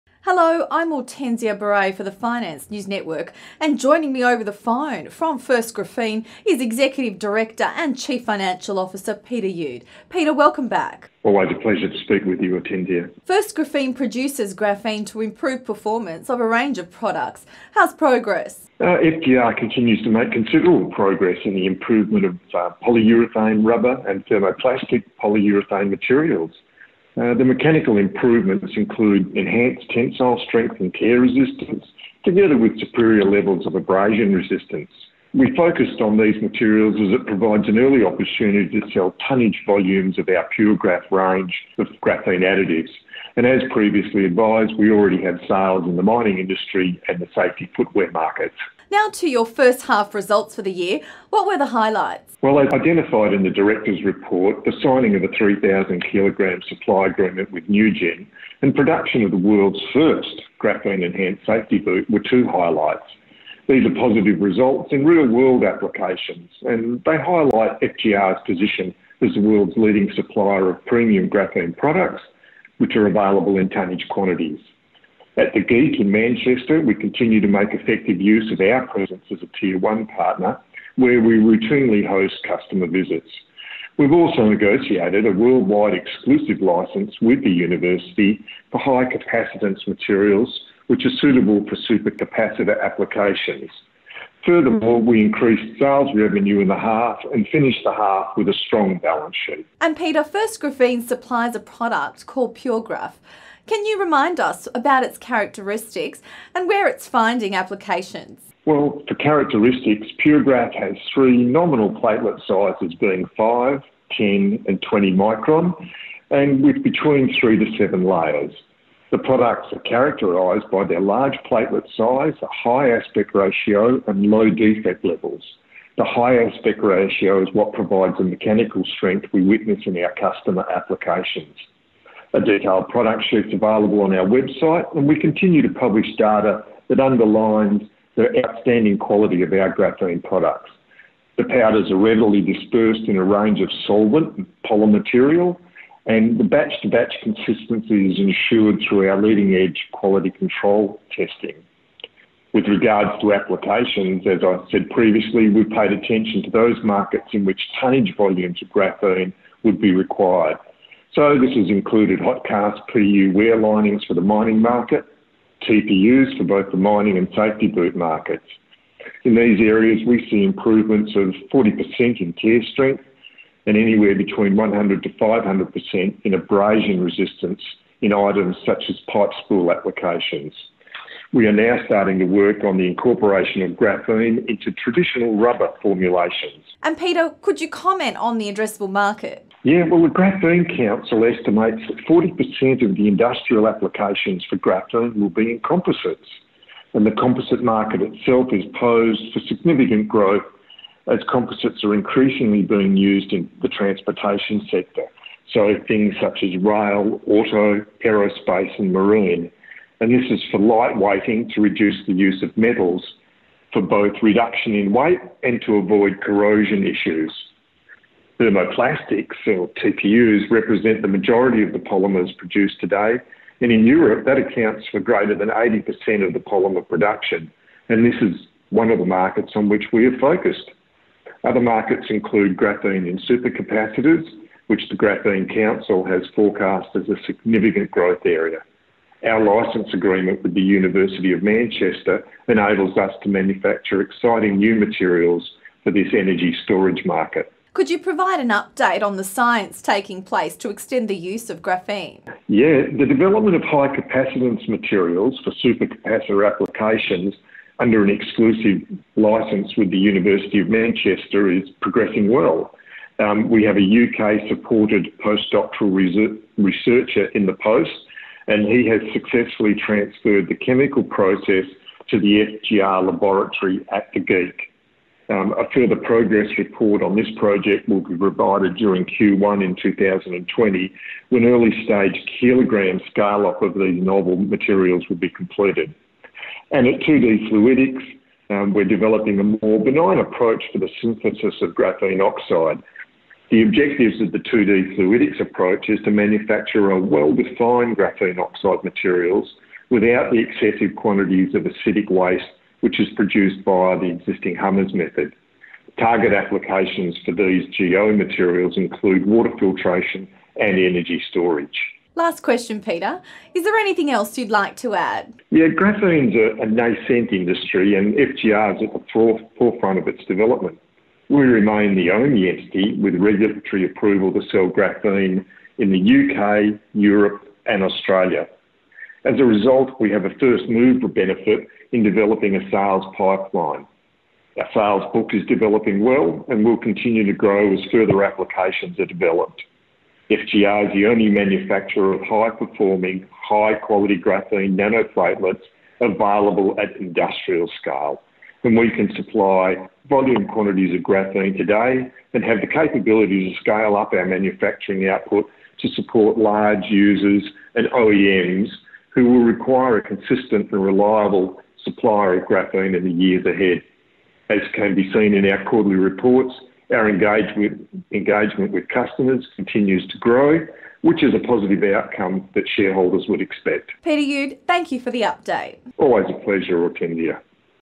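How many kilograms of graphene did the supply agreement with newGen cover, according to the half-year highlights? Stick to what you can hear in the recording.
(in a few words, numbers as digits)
3,000.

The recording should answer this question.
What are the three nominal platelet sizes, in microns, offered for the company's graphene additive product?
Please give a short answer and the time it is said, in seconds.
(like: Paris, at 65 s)
5, 10, and 20, at 113 s.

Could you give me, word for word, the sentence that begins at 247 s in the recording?
Could you provide an update on the science taking place to extend the use of graphene?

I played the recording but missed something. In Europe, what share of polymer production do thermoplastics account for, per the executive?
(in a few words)
greater than 80%.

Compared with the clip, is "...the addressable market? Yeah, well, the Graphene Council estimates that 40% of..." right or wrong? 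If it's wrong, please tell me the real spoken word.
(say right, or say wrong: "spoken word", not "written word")
right.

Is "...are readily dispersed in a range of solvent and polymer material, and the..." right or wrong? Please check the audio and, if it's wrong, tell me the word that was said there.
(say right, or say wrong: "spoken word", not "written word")
right.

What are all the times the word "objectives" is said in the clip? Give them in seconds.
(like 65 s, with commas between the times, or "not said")
293 s.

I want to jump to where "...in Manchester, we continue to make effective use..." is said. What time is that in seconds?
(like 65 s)
76 s.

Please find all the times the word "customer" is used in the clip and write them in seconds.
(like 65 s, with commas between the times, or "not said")
82 s, 130 s, 368 s.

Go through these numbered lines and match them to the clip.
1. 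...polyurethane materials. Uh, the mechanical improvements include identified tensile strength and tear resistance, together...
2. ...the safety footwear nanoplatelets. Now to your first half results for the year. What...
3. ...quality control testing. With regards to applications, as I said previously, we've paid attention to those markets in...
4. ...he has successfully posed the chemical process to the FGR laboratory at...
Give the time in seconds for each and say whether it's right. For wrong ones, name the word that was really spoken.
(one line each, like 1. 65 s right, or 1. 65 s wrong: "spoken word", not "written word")
1. 25 s wrong: "enhanced", not "identified"
2. 47 s wrong: "markets", not "nanoplatelets"
3. 149 s right
4. 268 s wrong: "transferred", not "posed".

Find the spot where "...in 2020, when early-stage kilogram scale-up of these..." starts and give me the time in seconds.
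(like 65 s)
279 s.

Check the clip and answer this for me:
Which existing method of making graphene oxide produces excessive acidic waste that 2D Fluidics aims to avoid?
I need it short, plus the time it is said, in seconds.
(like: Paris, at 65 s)
Hummers method, at 304 s.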